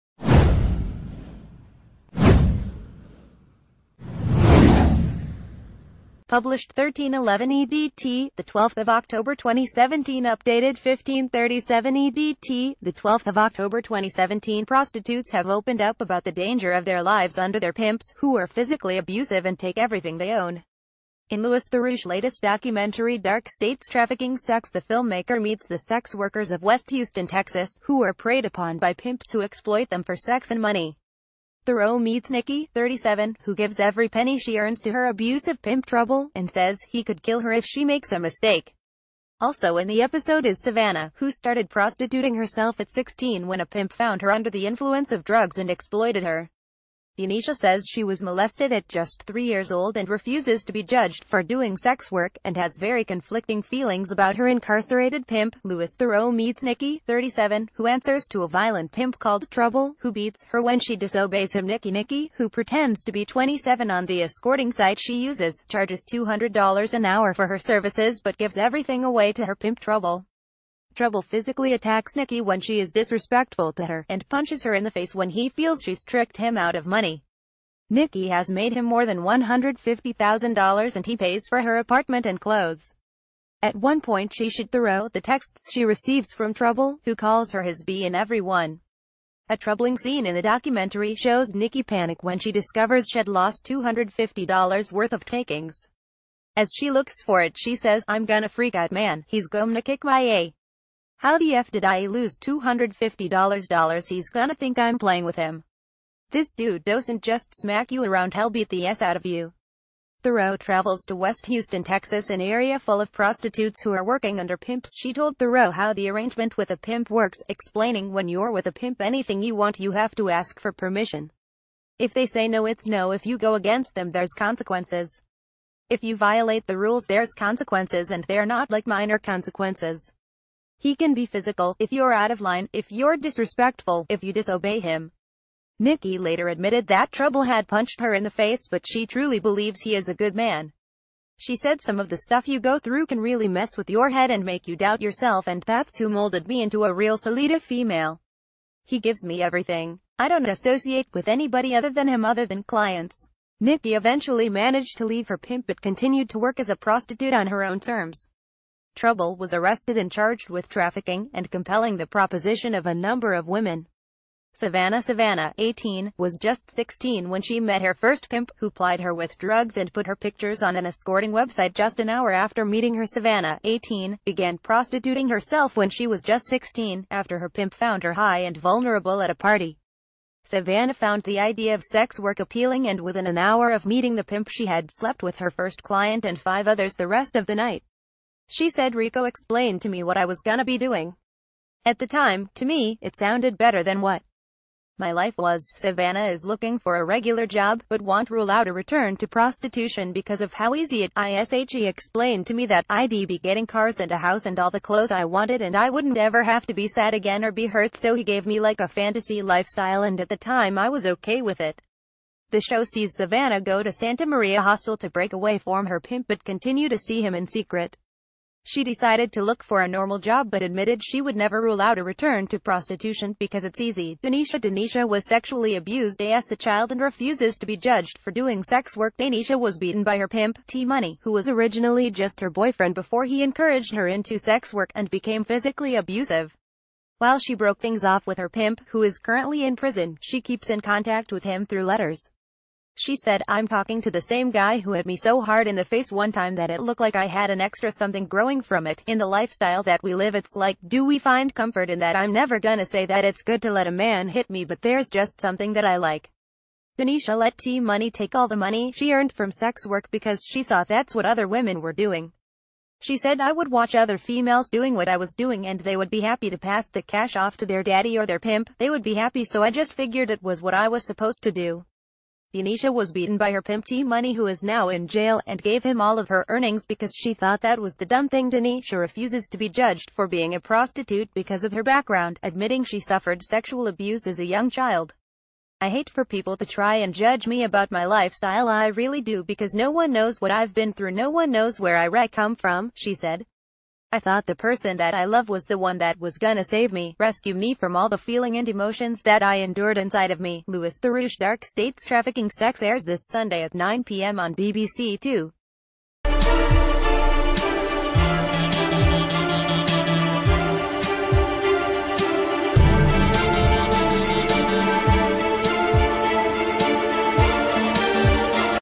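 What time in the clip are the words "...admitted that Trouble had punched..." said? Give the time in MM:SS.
02:16.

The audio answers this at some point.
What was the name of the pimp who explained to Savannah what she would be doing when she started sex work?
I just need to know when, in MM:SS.
03:08.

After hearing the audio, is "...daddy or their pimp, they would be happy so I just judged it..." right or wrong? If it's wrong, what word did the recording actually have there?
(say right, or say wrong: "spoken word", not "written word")
wrong: "figured", not "judged".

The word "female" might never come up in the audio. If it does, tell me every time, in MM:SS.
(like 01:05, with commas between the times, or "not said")
02:27, 04:24.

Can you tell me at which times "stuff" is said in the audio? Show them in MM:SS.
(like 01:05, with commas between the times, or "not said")
02:22.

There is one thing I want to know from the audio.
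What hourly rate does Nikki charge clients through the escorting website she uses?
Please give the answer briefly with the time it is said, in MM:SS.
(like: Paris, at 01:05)
$200, at 01:06.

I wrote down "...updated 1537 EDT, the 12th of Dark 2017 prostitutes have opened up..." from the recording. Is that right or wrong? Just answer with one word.
wrong.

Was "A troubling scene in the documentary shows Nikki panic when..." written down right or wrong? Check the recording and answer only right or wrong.
right.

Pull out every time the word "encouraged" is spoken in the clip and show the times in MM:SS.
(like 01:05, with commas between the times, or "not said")
03:53.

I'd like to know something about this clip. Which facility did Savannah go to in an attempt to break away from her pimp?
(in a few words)
Santa Maria Hostel.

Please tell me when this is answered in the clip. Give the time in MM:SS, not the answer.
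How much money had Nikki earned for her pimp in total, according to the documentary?
01:19.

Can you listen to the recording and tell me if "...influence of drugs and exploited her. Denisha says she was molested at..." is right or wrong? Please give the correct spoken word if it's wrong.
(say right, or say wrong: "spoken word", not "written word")
right.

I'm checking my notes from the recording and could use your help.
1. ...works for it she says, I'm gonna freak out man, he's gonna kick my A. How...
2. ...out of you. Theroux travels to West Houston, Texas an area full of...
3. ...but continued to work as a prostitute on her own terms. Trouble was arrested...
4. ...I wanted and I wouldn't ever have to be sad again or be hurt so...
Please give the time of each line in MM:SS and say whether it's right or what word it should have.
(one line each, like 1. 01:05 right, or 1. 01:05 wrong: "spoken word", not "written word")
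1. 01:36 wrong: "looks", not "works"
2. 01:49 right
3. 02:35 right
4. 03:25 right.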